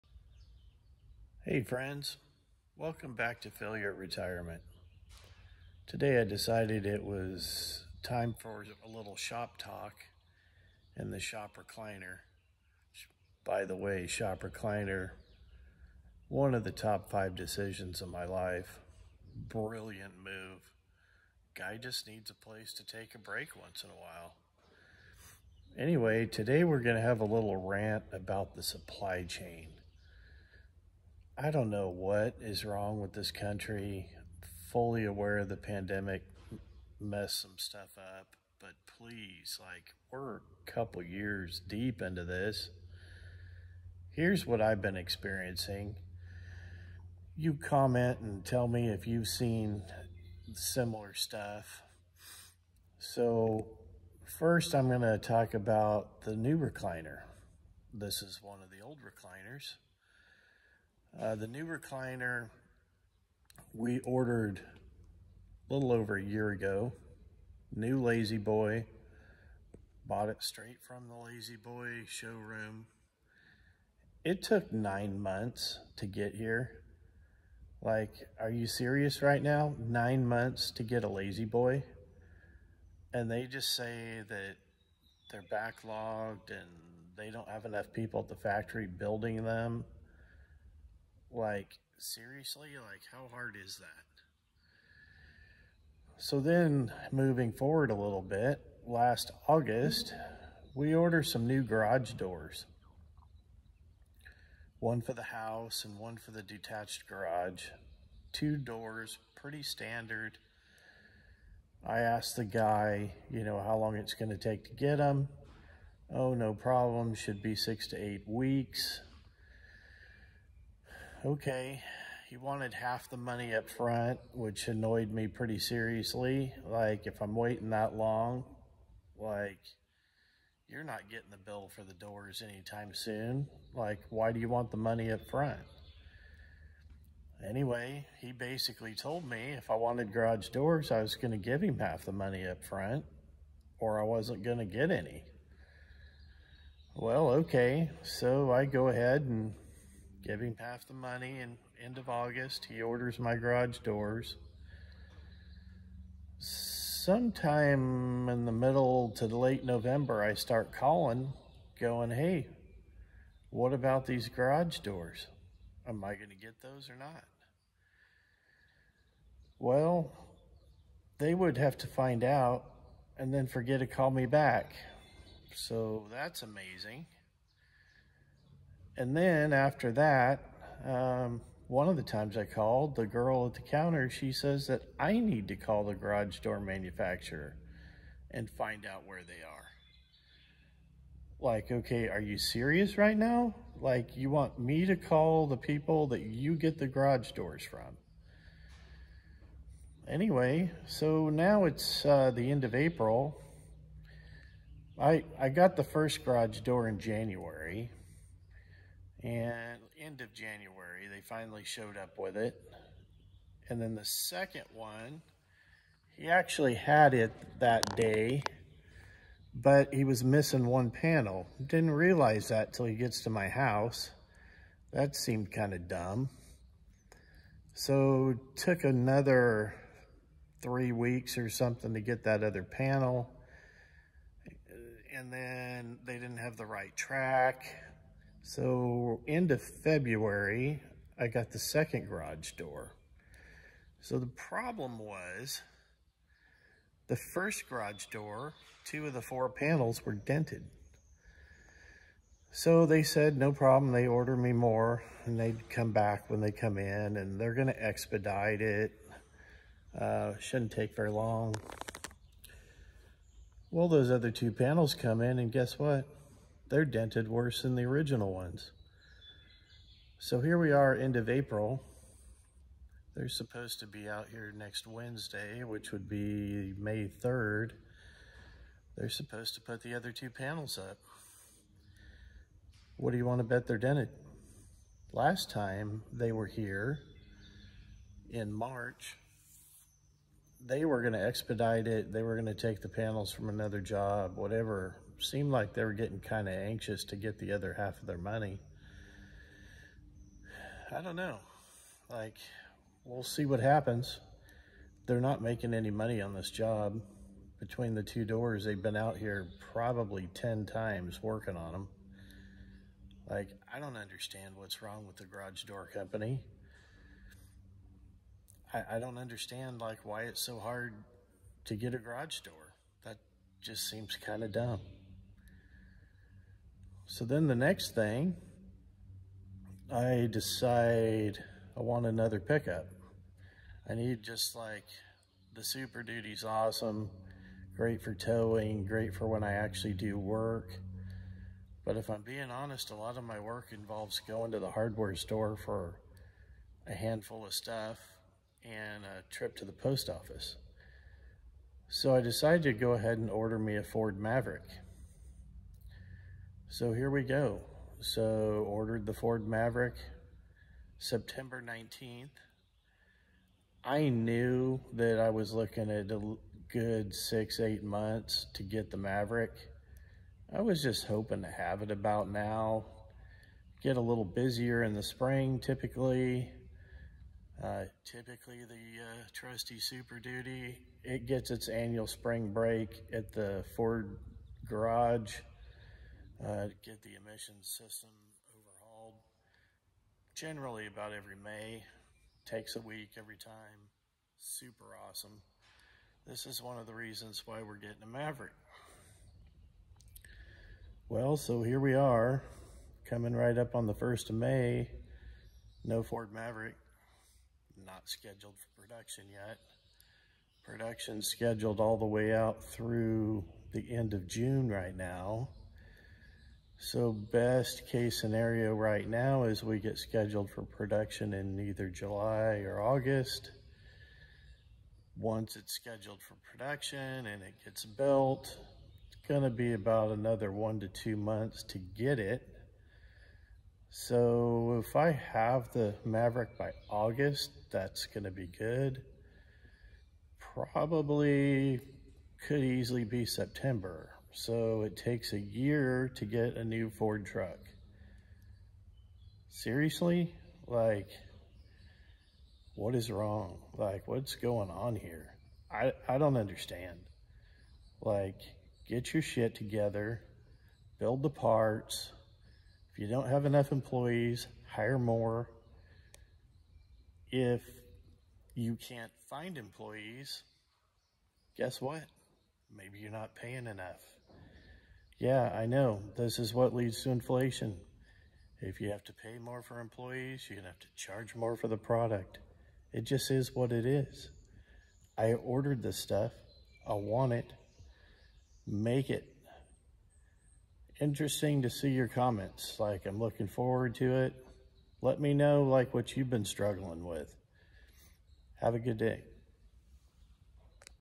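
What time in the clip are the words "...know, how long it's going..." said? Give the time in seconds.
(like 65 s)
113 s.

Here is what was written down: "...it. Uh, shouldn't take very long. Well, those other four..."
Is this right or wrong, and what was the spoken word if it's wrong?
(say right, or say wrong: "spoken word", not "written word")
wrong: "two", not "four".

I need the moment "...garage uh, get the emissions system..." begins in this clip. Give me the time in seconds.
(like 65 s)
384 s.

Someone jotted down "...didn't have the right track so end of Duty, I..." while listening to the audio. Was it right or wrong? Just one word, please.
wrong.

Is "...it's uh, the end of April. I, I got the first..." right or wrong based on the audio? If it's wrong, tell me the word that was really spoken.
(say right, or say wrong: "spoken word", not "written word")
right.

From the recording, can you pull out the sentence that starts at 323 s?
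That just seems kind of dumb.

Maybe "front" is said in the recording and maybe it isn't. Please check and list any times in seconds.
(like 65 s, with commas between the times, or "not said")
123 s, 135 s, 142 s.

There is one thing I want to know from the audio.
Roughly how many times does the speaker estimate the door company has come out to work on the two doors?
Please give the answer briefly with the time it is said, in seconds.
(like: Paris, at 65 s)
10, at 310 s.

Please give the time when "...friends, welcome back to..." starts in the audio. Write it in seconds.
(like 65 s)
1 s.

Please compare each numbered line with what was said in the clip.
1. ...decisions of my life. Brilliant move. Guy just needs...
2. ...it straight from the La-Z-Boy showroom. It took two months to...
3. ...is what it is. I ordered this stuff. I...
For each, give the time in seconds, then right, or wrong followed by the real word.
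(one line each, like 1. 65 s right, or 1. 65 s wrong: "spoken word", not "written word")
1. 17 s right
2. 70 s wrong: "nine", not "two"
3. 483 s right.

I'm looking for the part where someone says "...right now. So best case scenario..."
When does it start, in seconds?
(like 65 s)
414 s.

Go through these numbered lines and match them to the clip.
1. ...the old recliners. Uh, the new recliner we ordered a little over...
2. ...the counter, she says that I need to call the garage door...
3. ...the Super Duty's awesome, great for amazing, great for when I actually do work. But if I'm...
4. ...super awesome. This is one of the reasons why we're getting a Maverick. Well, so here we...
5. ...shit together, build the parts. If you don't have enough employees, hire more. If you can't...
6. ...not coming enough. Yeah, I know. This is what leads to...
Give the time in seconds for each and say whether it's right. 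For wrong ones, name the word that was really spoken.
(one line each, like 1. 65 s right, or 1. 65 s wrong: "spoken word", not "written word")
1. 58 s right
2. 183 s right
3. 335 s wrong: "towing", not "amazing"
4. 394 s right
5. 459 s right
6. 473 s wrong: "paying", not "coming".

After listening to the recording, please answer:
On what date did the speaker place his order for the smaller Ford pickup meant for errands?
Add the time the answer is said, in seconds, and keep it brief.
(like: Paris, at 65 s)
September 19, at 360 s.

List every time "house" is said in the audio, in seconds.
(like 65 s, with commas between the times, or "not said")
105 s, 223 s.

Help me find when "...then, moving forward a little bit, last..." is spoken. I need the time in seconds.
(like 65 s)
96 s.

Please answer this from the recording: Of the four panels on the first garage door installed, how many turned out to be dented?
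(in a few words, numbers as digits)
2.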